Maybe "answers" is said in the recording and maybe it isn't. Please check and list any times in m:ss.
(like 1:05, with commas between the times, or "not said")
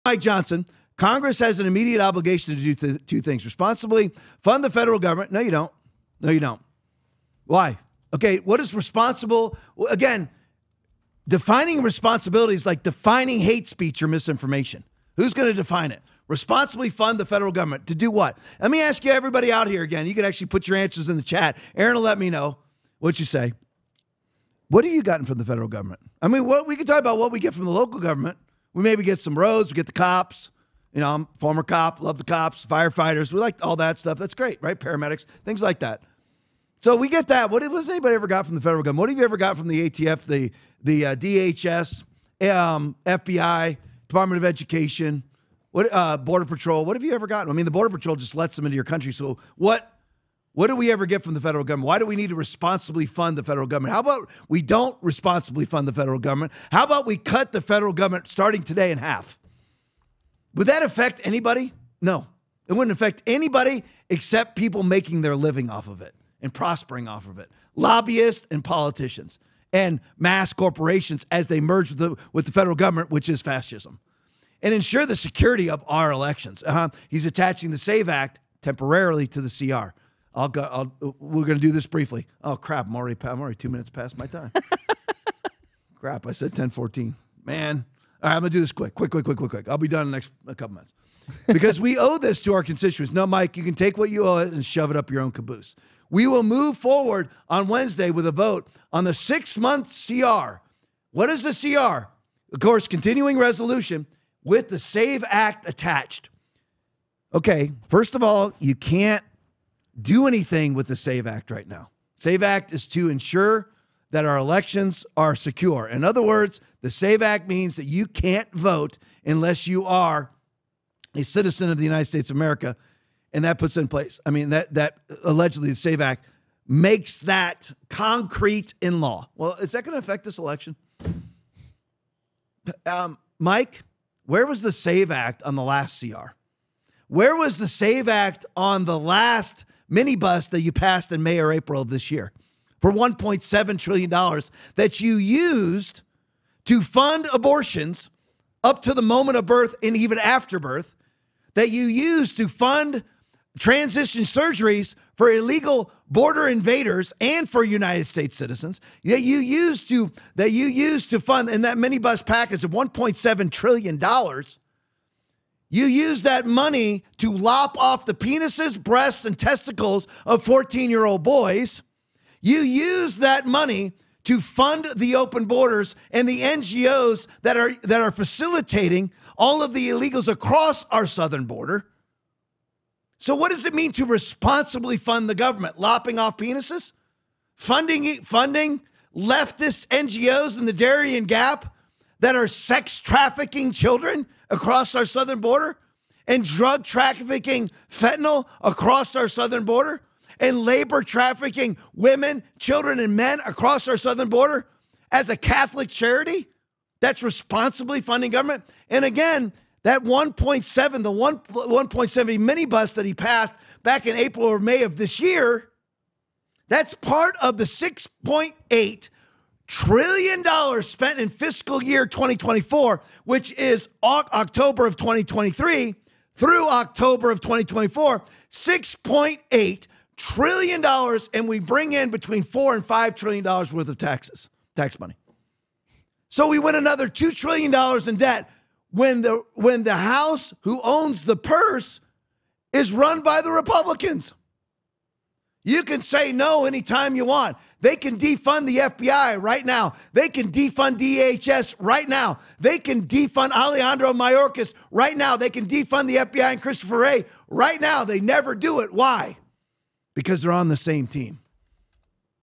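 0:20.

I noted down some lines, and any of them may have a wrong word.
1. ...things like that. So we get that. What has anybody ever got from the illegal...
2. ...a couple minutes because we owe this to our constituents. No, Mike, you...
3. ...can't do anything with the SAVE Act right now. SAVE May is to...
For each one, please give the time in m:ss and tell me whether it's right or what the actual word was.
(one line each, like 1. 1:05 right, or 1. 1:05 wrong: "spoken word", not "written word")
1. 0:35 wrong: "federal", not "illegal"
2. 1:30 right
3. 1:48 wrong: "Act", not "May".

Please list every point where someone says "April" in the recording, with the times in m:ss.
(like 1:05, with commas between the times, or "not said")
2:21, 3:34.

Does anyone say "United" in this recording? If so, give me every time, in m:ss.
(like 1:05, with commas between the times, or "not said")
2:01, 2:37.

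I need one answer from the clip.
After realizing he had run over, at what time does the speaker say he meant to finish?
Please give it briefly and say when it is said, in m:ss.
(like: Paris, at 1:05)
10:14, at 1:26.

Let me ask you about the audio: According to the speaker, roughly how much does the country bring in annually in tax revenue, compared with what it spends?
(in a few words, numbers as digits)
between 4 and 5 trillion dollars.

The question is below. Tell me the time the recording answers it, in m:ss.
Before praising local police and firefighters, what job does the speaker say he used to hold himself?
0:31.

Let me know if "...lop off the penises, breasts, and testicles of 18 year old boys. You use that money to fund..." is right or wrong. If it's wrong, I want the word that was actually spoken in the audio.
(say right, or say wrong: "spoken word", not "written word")
wrong: "14", not "18".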